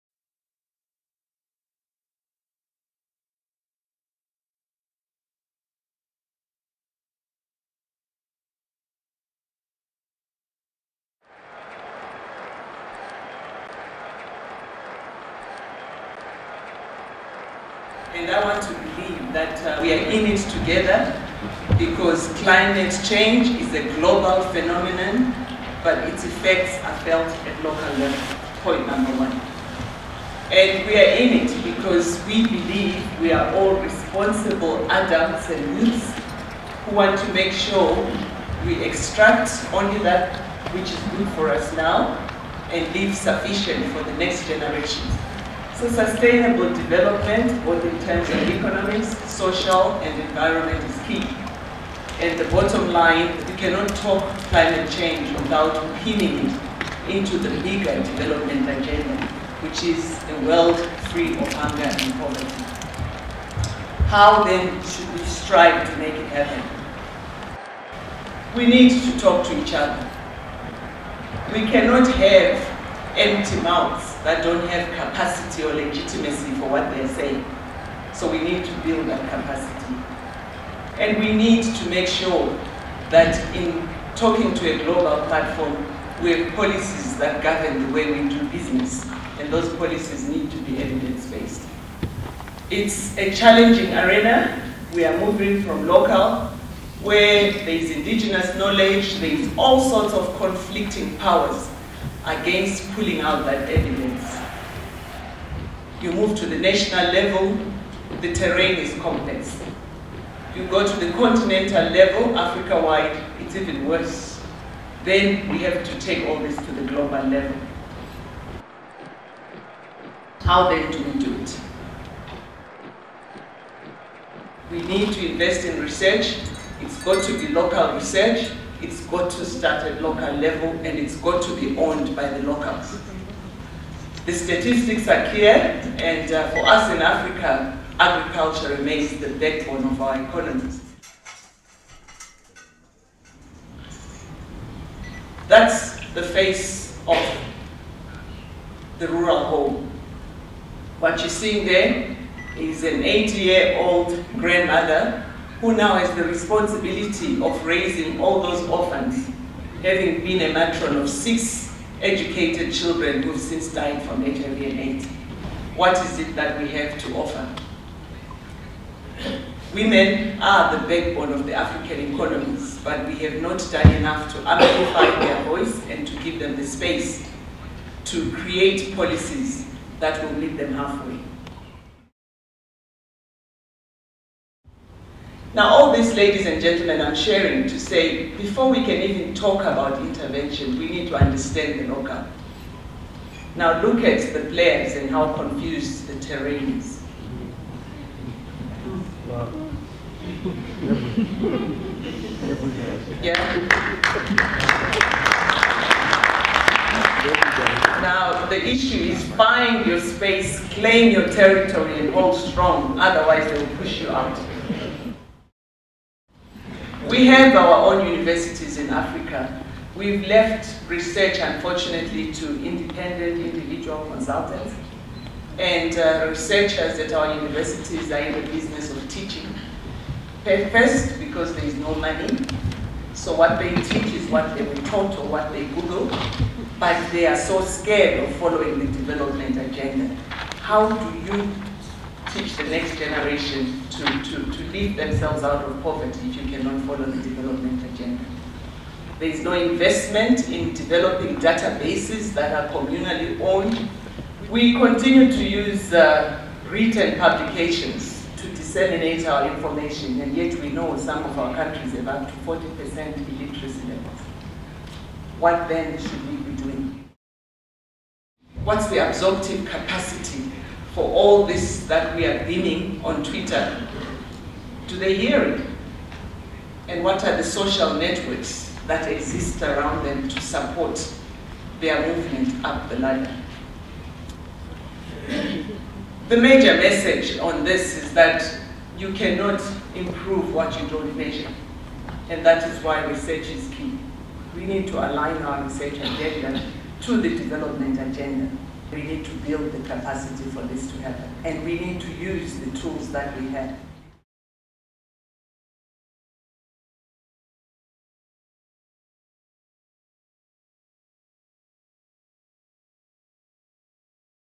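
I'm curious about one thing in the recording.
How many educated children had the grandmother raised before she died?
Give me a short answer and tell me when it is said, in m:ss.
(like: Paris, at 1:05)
6, at 2:41.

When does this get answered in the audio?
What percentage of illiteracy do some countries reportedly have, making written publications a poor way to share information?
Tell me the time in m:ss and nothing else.
4:22.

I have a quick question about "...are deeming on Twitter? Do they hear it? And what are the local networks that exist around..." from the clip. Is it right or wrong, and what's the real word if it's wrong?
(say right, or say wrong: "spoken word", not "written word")
wrong: "social", not "local".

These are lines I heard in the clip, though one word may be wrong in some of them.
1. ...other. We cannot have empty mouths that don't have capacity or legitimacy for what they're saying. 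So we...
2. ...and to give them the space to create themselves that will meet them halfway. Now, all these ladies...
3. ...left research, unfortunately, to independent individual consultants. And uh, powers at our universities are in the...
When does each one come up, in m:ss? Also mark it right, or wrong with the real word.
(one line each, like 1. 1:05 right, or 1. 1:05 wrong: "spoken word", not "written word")
1. 1:09 right
2. 2:55 wrong: "policies", not "themselves"
3. 3:40 wrong: "researchers", not "powers".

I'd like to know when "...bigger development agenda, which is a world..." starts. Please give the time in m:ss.
0:57.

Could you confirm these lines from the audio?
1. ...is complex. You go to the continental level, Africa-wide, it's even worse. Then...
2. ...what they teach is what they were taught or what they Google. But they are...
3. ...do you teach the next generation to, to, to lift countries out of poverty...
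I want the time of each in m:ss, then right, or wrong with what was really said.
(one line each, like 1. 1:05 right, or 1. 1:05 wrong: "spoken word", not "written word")
1. 1:48 right
2. 3:53 right
3. 4:00 wrong: "themselves", not "countries".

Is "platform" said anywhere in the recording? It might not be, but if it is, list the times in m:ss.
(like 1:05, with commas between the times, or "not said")
1:25.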